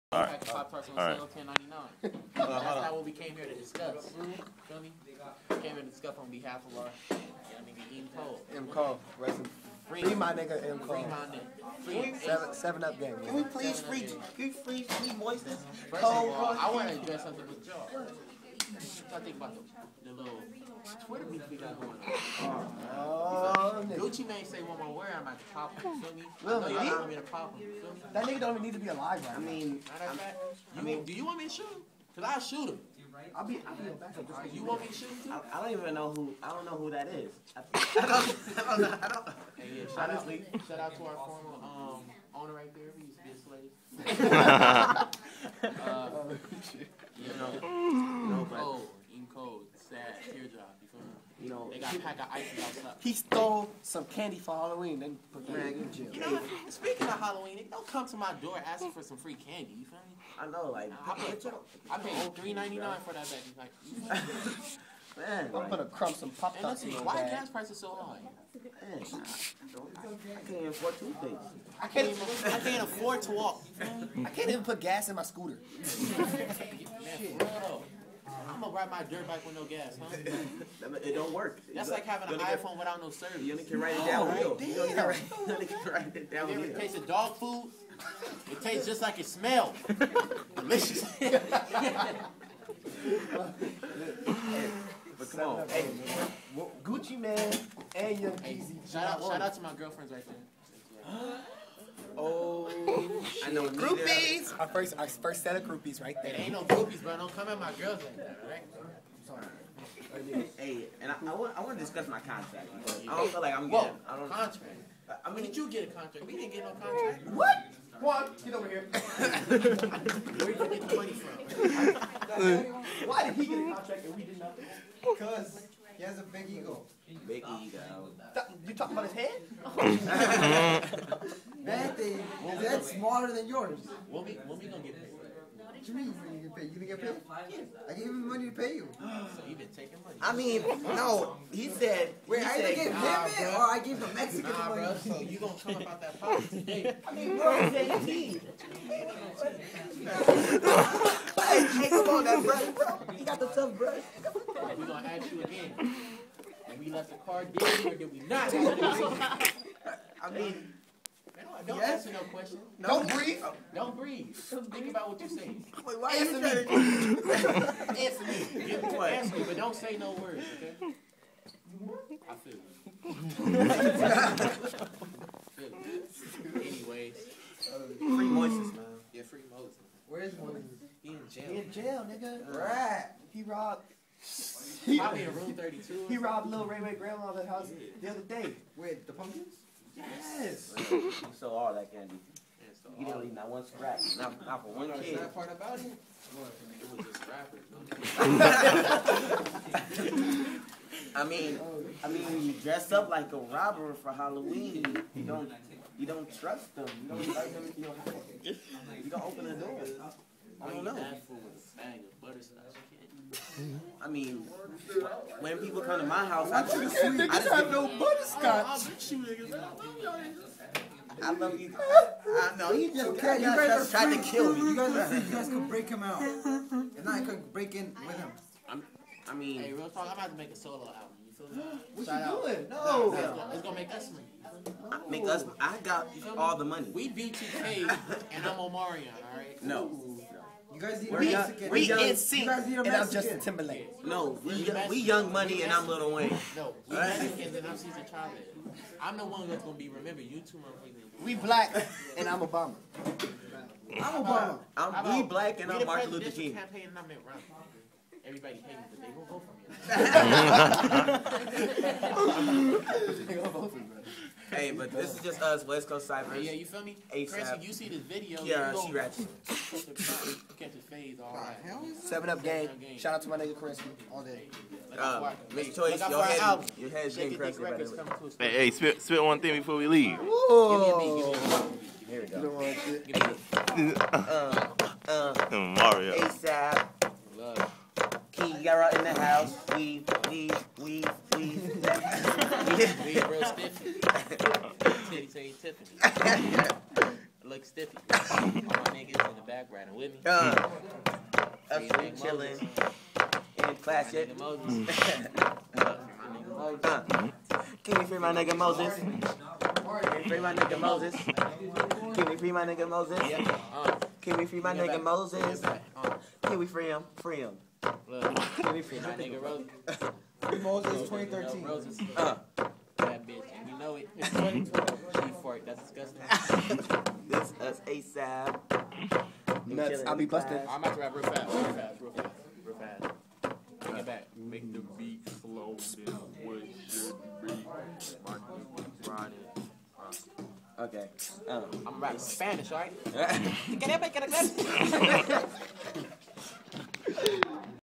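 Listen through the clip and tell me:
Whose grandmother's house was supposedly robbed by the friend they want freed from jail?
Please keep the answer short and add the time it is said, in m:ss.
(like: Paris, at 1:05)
Lil Ray Ray, at 3:06.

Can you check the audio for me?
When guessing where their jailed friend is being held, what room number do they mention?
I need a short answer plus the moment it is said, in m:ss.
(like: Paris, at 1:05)
32, at 3:05.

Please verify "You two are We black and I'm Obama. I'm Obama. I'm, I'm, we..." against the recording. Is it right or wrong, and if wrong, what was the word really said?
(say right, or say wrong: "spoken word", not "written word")
right.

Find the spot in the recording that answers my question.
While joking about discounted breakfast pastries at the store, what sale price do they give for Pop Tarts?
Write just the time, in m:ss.
0:01.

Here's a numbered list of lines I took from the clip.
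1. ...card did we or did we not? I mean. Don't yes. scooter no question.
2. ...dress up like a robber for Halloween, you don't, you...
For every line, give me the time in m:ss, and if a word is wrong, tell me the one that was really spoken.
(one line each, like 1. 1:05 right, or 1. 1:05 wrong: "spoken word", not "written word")
1. 2:37 wrong: "answer", not "scooter"
2. 3:22 right.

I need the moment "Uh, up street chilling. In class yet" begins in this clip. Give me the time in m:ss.
5:00.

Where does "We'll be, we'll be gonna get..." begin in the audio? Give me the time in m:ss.
2:14.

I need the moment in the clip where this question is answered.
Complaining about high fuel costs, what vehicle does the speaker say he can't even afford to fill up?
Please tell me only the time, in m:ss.
1:15.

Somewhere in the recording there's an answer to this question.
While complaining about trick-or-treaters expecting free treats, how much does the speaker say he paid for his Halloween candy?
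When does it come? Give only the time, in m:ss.
1:02.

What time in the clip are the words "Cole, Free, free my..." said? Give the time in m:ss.
0:08.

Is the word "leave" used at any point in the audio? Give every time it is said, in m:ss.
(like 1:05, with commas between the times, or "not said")
3:13, 4:39.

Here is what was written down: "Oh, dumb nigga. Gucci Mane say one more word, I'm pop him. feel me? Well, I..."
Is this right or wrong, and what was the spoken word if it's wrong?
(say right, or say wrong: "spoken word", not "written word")
right.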